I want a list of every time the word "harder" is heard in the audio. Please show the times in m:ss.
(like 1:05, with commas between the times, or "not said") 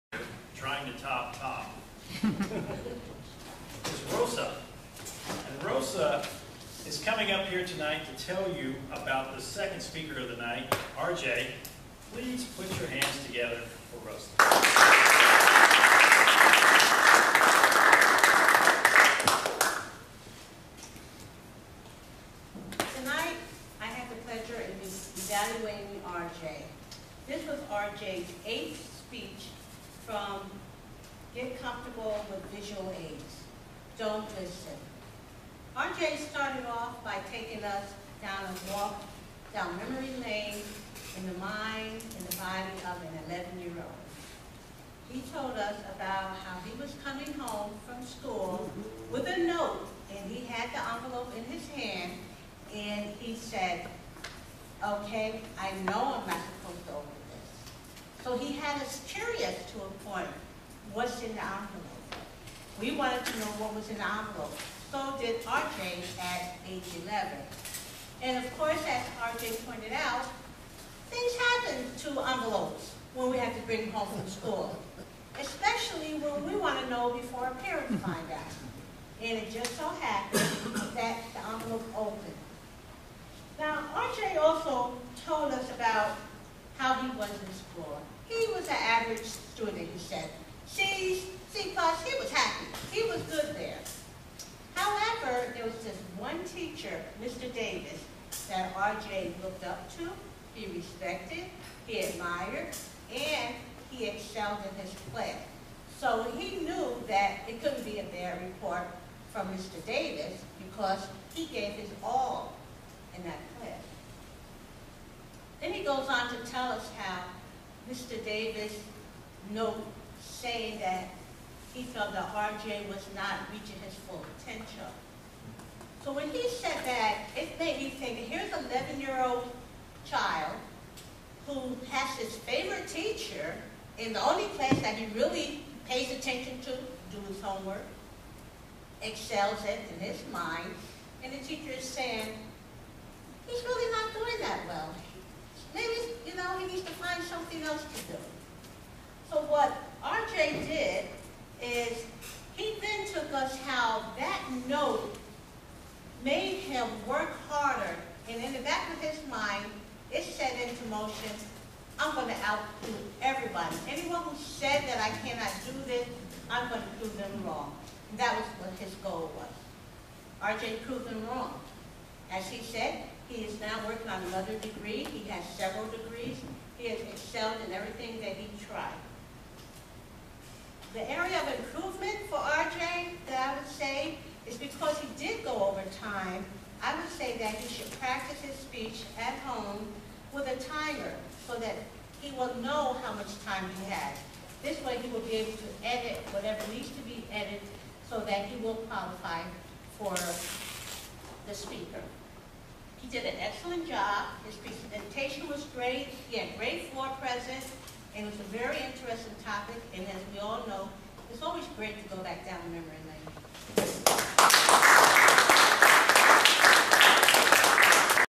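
2:37.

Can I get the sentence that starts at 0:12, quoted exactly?
Please put your hands together for Rosa.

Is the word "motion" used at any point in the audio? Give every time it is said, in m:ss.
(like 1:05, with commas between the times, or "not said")
2:40.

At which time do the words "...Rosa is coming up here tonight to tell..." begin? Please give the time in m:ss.
0:05.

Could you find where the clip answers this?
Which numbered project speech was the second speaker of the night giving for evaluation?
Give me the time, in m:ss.
0:28.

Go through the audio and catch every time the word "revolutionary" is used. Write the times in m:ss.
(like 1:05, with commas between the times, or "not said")
not said.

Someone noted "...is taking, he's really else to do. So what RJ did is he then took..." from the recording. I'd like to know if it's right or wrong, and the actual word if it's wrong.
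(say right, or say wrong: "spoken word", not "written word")
wrong: "saying", not "taking".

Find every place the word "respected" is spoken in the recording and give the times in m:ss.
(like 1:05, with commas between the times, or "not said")
1:40.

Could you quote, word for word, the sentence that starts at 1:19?
And it just so happened that the envelope opened.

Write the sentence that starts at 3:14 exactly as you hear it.
This way he will be able to edit whatever needs to be edited so that he will qualify for the speaker.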